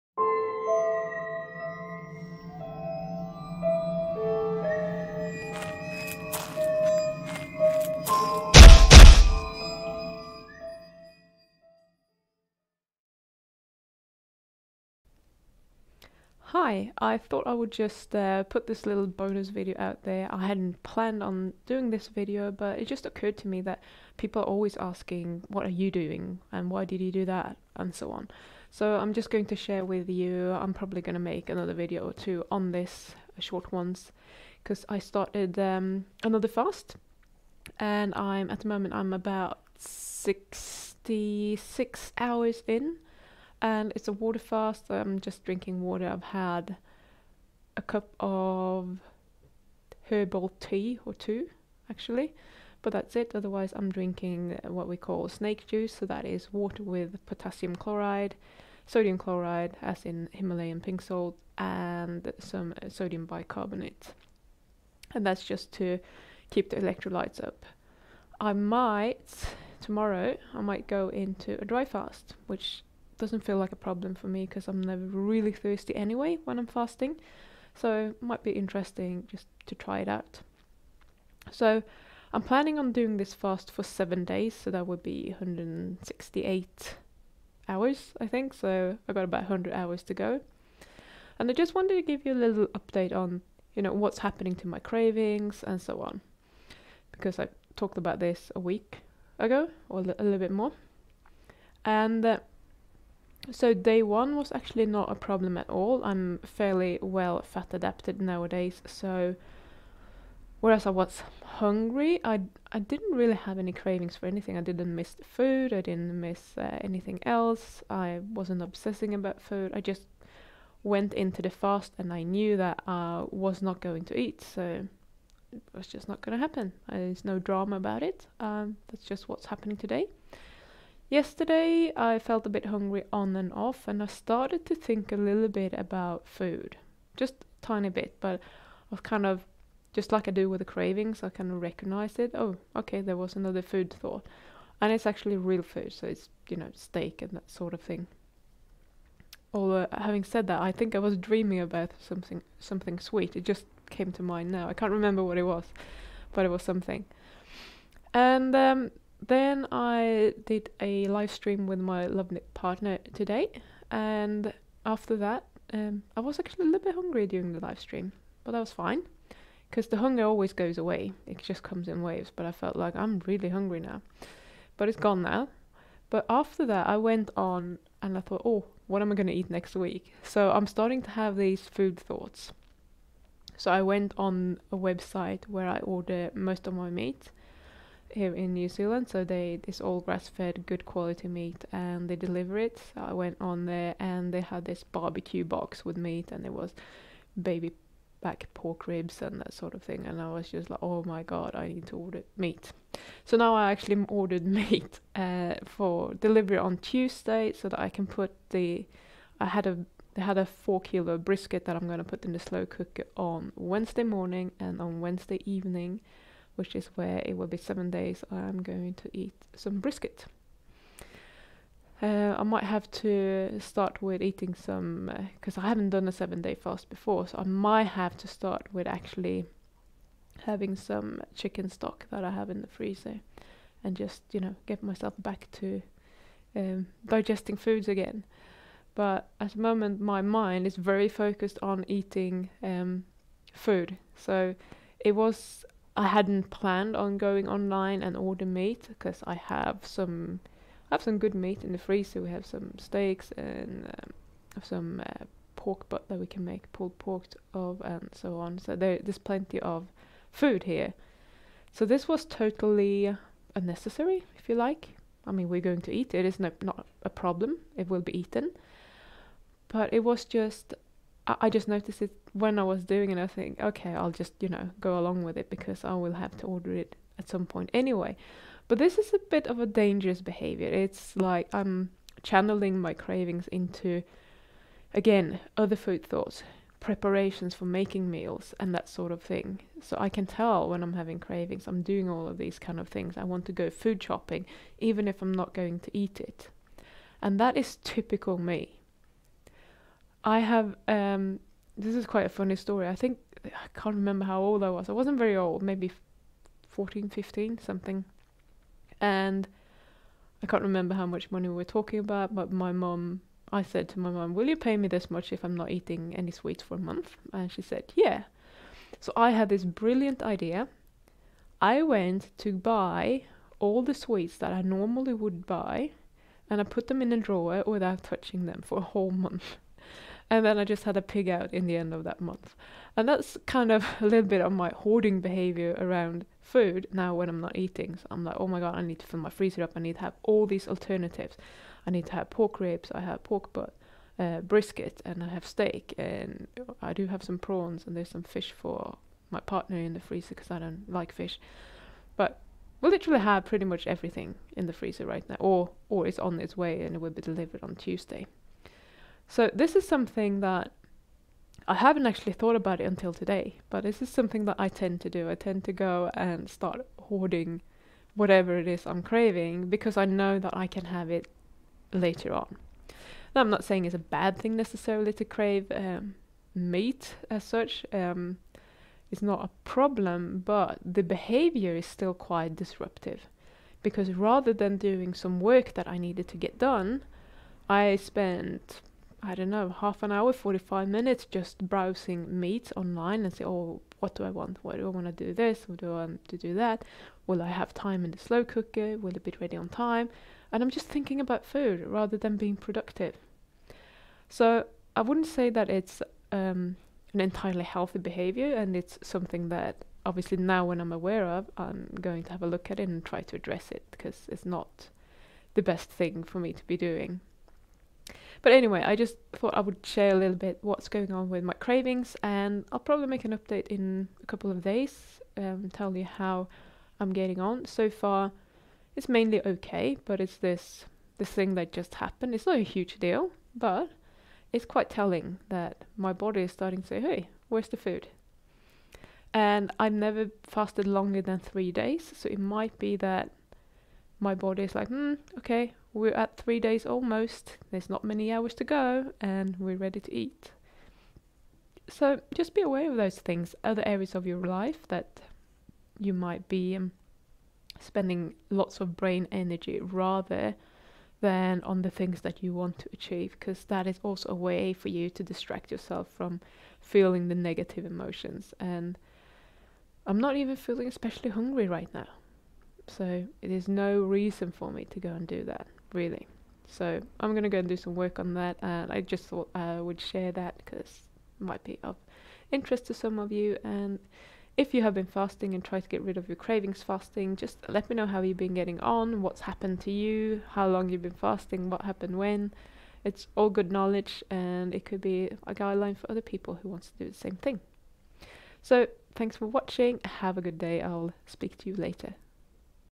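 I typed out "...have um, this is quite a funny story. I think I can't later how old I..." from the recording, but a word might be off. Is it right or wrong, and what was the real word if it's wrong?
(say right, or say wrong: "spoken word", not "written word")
wrong: "remember", not "later".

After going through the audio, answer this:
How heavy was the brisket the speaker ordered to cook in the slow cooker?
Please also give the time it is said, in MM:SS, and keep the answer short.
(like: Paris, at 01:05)
4 kilo, at 03:30.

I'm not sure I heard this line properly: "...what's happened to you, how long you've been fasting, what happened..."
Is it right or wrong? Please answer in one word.
right.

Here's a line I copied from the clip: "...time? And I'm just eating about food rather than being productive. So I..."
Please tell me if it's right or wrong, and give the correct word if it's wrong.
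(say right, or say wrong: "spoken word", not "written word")
wrong: "thinking", not "eating".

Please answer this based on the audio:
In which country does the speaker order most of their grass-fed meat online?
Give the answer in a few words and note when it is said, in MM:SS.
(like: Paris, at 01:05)
New Zealand, at 03:08.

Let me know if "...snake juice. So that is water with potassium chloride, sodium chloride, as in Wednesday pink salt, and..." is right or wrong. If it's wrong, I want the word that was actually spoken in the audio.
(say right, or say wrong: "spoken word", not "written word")
wrong: "Himalayan", not "Wednesday".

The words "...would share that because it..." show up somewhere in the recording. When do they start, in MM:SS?
07:59.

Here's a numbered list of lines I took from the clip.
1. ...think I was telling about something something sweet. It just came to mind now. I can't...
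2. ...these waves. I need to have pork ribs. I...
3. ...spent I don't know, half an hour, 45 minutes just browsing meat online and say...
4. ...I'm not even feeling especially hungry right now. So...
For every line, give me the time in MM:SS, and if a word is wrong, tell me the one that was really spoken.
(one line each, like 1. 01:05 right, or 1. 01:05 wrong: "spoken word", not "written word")
1. 02:30 wrong: "dreaming", not "telling"
2. 05:40 wrong: "alternatives", not "waves"
3. 06:27 right
4. 07:50 right.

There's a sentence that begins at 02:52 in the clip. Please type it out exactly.
But I felt like I'm really hungry now, but it's gone now.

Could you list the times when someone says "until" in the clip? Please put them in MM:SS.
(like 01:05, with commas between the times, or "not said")
06:02.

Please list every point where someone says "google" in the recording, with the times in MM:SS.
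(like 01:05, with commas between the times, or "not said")
not said.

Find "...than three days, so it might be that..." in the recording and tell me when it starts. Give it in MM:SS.
07:21.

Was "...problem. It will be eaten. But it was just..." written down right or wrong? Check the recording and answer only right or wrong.
right.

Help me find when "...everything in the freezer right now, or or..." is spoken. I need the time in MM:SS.
05:53.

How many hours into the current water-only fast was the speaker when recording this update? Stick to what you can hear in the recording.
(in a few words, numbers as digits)
66.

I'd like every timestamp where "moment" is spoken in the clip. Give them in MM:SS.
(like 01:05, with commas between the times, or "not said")
00:38, 03:59.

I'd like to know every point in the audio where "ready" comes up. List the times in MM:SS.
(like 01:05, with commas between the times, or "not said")
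06:39, 07:29.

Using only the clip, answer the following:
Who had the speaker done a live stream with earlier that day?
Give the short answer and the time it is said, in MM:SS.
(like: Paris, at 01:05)
LoveNip partner, at 02:42.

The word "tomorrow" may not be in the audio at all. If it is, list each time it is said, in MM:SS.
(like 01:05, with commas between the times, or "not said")
01:09.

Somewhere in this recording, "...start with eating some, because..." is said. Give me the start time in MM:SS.
03:43.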